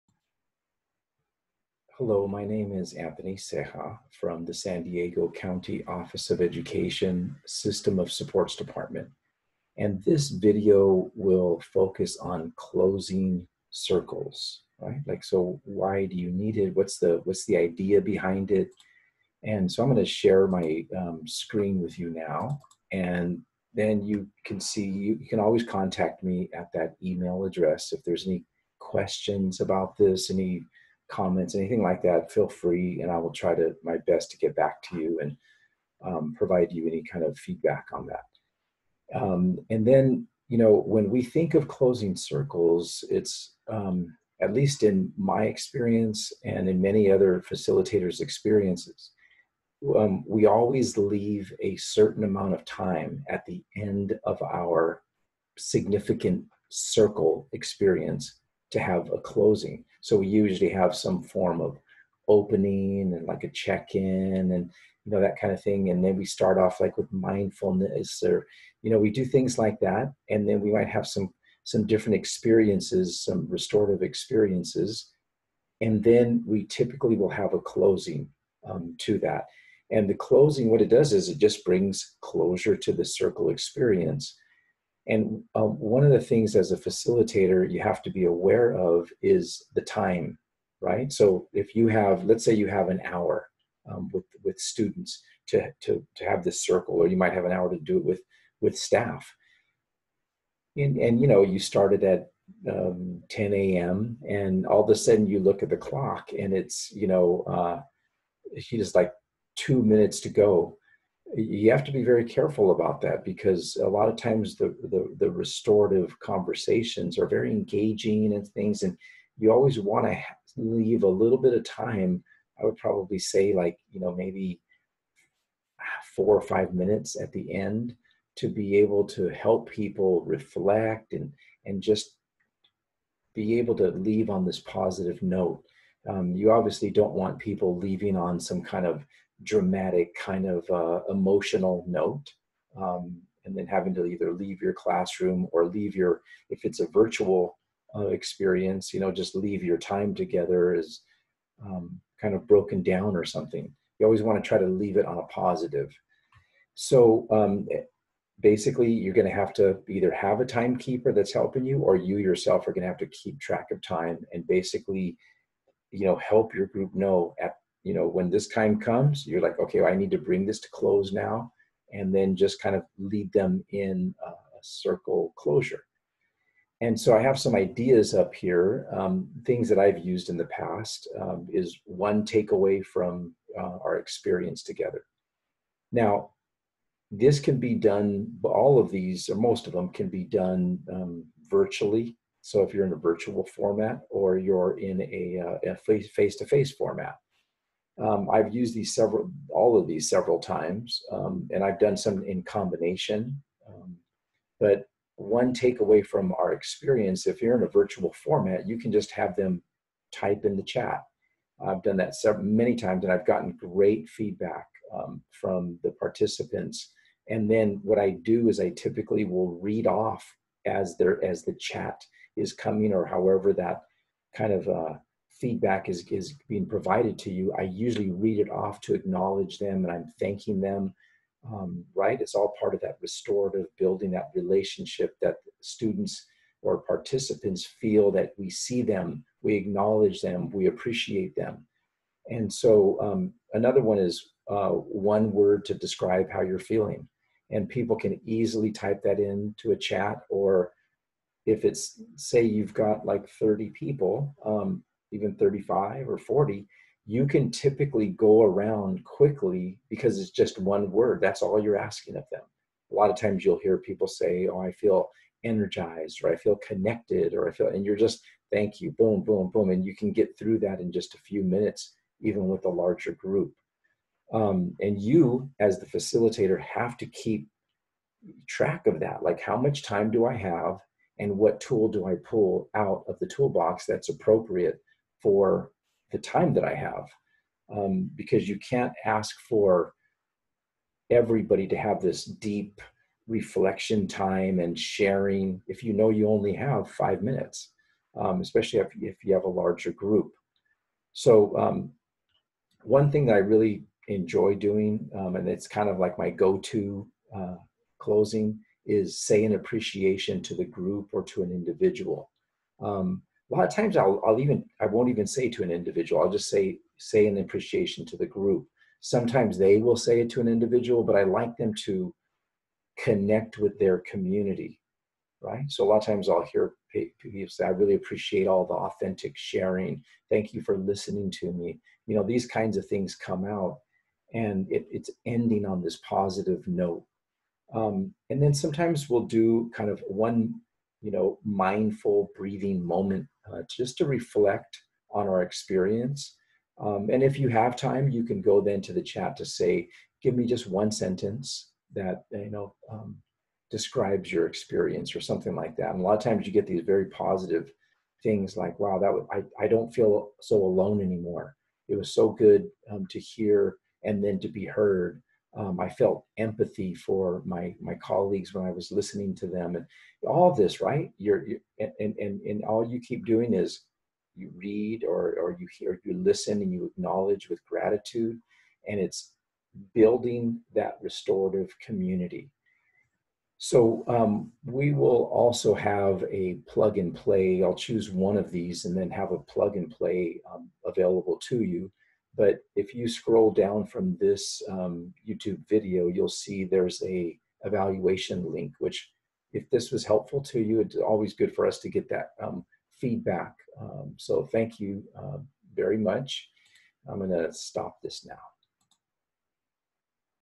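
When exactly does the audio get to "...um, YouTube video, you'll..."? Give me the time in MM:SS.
06:34.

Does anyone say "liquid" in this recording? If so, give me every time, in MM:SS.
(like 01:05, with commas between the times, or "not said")
not said.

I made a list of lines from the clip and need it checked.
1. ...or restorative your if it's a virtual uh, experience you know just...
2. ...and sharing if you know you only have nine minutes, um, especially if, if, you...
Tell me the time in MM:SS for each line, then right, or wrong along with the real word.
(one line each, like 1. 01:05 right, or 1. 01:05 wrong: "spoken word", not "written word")
1. 02:25 wrong: "leave", not "restorative"
2. 04:54 wrong: "five", not "nine".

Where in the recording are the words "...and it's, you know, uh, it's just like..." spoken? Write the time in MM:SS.
01:46.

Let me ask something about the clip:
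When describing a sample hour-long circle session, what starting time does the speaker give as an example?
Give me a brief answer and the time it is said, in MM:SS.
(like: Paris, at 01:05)
10 a.m., at 01:43.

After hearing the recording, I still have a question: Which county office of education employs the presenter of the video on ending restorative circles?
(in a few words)
San Diego County.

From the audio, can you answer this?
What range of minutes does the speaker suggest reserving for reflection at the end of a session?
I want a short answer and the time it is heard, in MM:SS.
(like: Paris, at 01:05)
4 or 5, at 02:06.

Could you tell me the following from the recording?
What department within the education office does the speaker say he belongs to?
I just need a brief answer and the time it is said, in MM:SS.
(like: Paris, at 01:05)
System of Supports, at 00:07.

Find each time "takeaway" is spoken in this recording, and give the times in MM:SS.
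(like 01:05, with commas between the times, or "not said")
03:02, 03:25.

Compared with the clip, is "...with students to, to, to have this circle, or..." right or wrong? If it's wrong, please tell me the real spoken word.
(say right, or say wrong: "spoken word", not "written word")
right.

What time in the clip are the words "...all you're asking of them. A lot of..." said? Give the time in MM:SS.
04:21.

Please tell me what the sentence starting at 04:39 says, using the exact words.
Like, how much time do I have?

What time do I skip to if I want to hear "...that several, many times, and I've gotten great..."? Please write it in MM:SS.
03:31.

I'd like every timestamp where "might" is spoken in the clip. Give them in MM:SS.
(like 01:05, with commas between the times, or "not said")
01:10, 01:37.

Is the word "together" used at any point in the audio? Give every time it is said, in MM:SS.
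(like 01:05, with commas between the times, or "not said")
02:30, 03:04.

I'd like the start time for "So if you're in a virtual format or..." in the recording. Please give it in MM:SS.
03:12.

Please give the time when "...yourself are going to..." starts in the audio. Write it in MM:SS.
02:42.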